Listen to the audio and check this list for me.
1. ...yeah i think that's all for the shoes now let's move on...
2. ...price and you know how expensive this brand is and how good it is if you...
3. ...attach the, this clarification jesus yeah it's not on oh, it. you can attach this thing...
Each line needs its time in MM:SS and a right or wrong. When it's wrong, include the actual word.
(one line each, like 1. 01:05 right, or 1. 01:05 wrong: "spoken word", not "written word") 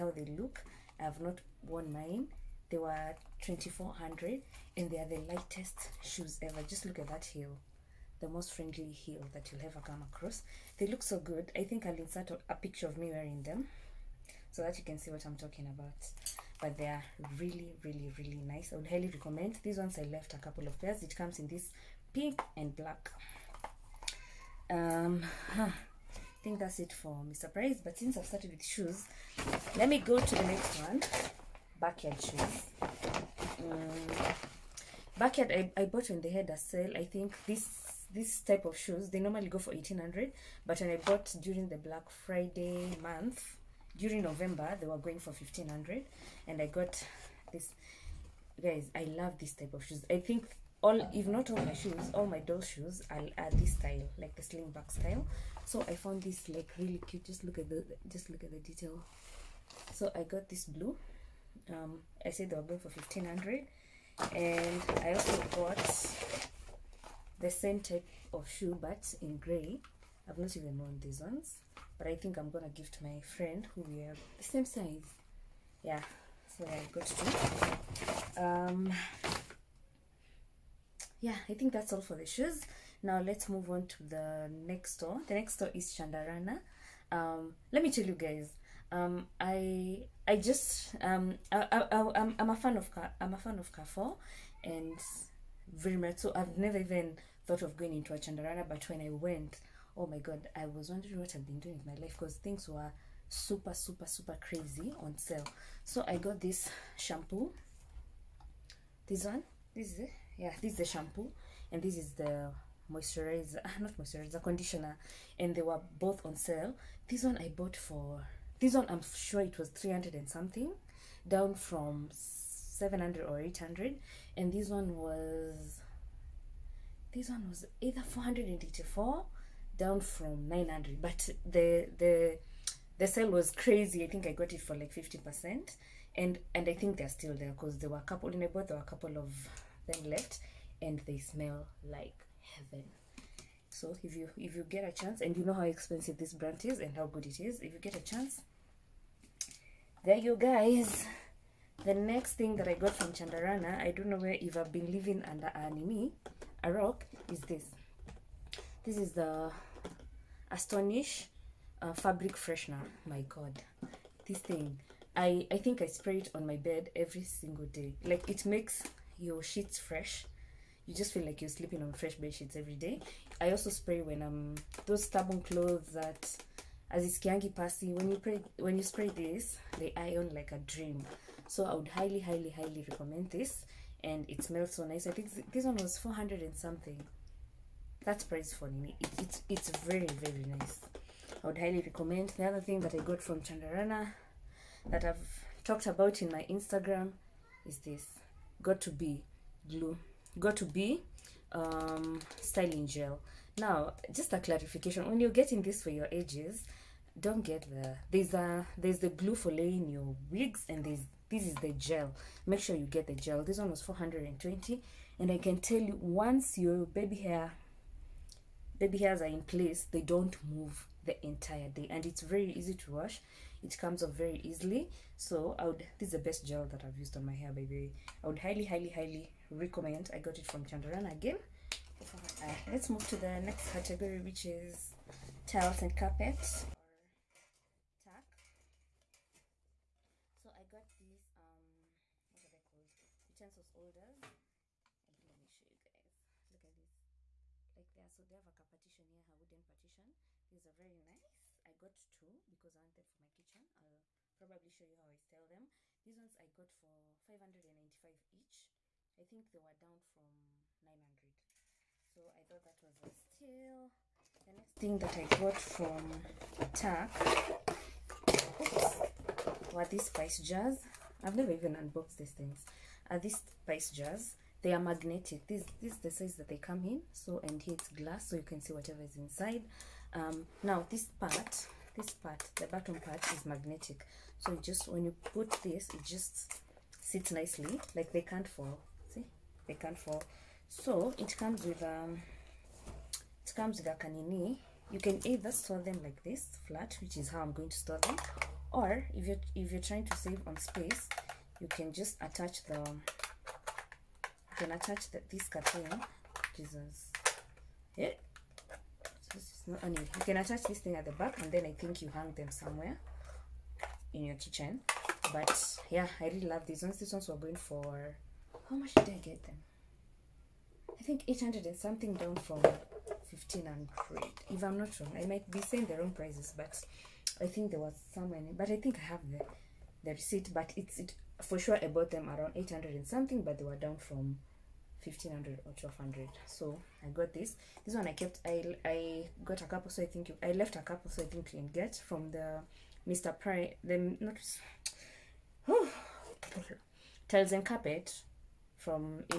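1. 01:21 right
2. 02:24 wrong: "chance", not "price"
3. 05:04 wrong: "cartoon", not "clarification".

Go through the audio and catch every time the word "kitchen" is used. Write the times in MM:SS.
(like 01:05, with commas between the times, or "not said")
04:13, 05:14.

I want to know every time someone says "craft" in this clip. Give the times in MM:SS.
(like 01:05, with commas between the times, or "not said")
not said.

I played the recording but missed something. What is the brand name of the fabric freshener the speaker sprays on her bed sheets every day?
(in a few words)
Astonish.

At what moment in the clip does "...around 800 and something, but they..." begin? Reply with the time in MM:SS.
05:32.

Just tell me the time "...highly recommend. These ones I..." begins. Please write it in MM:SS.
00:18.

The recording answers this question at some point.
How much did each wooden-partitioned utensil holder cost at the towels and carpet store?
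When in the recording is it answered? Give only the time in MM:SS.
04:17.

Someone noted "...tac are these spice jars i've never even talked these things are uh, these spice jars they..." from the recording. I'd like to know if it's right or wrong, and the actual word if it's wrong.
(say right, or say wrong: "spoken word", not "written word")
wrong: "unboxed", not "talked".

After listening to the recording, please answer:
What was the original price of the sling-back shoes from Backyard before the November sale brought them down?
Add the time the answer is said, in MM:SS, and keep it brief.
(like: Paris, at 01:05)
1800, at 00:39.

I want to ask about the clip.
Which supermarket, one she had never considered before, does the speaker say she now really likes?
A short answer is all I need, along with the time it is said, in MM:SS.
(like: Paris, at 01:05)
Carrefour, at 01:33.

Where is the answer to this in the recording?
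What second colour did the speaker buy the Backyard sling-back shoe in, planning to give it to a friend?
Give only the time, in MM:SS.
01:09.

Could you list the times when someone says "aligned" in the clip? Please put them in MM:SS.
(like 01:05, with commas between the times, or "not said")
not said.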